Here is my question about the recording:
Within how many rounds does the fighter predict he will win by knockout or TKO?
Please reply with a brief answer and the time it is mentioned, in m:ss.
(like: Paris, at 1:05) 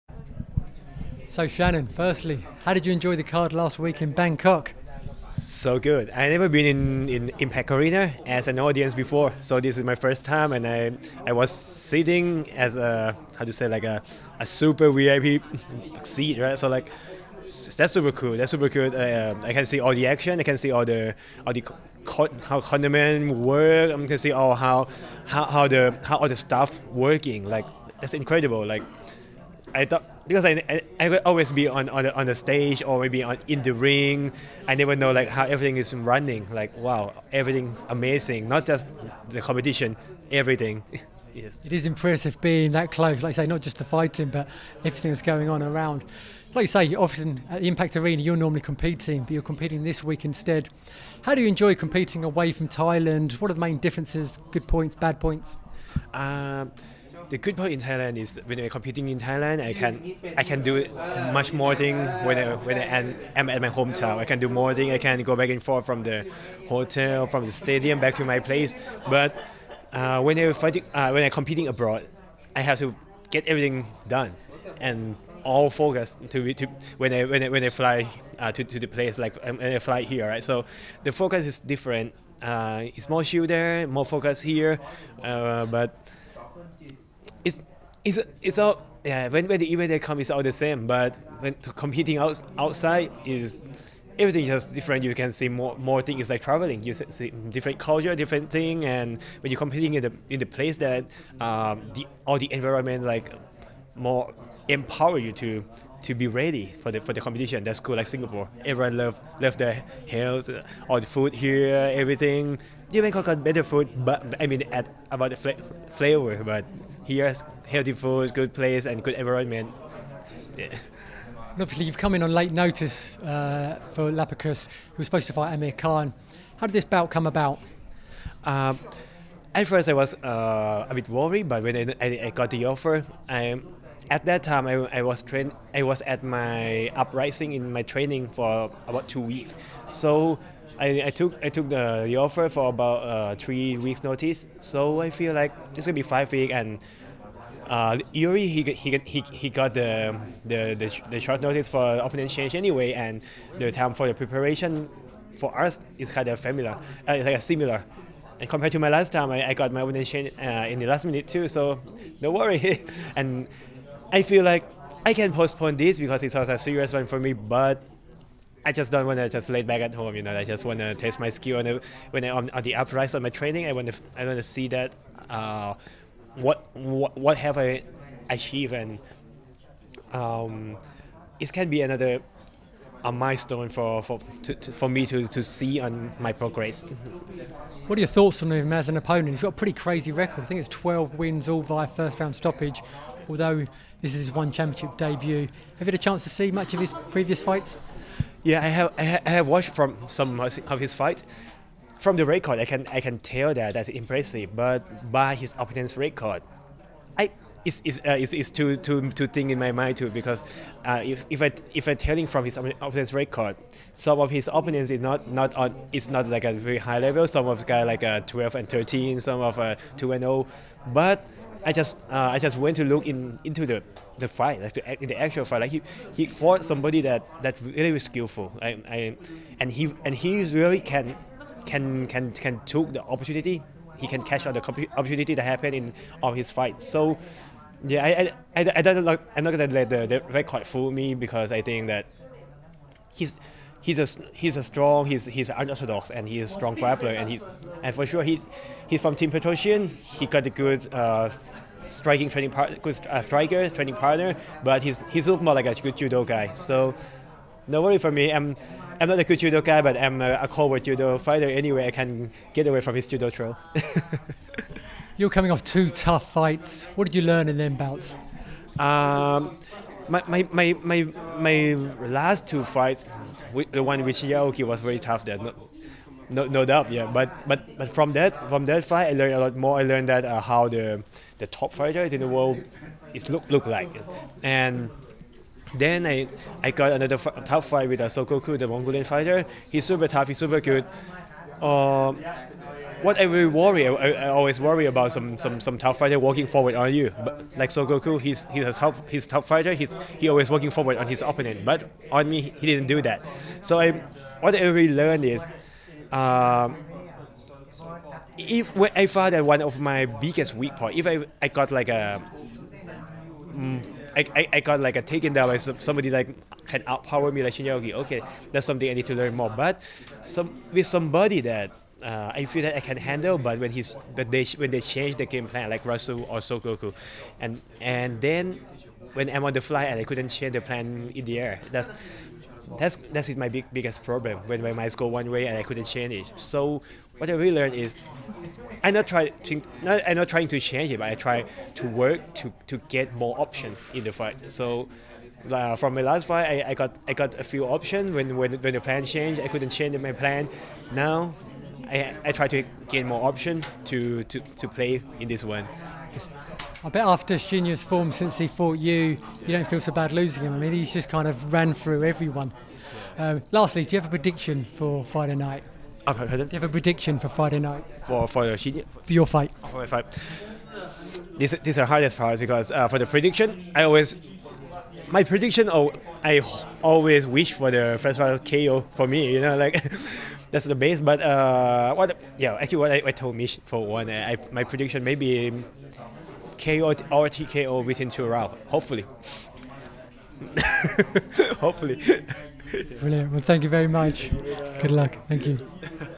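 2, at 6:28.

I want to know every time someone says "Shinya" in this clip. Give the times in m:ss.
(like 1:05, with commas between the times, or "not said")
4:34, 5:17, 5:57, 6:08.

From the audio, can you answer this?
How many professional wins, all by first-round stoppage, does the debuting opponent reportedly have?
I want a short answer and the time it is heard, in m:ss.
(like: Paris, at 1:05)
12, at 3:10.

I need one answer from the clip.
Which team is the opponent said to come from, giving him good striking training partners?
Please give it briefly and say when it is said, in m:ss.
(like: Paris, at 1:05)
Team Petrosian, at 4:09.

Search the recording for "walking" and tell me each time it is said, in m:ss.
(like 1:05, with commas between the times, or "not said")
4:56, 5:00.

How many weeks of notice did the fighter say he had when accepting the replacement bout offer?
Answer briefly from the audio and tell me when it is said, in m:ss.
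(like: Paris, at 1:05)
3 weeks, at 2:23.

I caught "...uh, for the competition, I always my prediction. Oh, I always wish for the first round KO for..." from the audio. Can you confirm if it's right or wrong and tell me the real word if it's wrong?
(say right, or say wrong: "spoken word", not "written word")
wrong: "prediction", not "competition".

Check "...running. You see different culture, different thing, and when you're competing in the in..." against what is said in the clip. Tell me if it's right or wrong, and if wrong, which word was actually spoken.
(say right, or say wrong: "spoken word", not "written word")
wrong: "traveling", not "running".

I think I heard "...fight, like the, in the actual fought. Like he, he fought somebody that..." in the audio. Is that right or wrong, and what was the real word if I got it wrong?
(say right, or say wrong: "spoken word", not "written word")
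wrong: "fight", not "fought".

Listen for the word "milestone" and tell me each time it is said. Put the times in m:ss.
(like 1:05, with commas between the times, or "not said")
3:03.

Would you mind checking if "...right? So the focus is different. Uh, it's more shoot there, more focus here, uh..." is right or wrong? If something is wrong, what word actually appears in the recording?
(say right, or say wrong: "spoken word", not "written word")
right.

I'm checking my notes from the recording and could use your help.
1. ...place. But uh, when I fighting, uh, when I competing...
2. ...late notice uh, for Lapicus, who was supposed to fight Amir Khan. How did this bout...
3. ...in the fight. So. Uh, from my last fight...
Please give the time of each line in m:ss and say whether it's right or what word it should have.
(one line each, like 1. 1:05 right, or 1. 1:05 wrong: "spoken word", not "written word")
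1. 1:08 right
2. 2:02 right
3. 5:43 right.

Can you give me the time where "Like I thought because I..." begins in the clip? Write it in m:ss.
0:28.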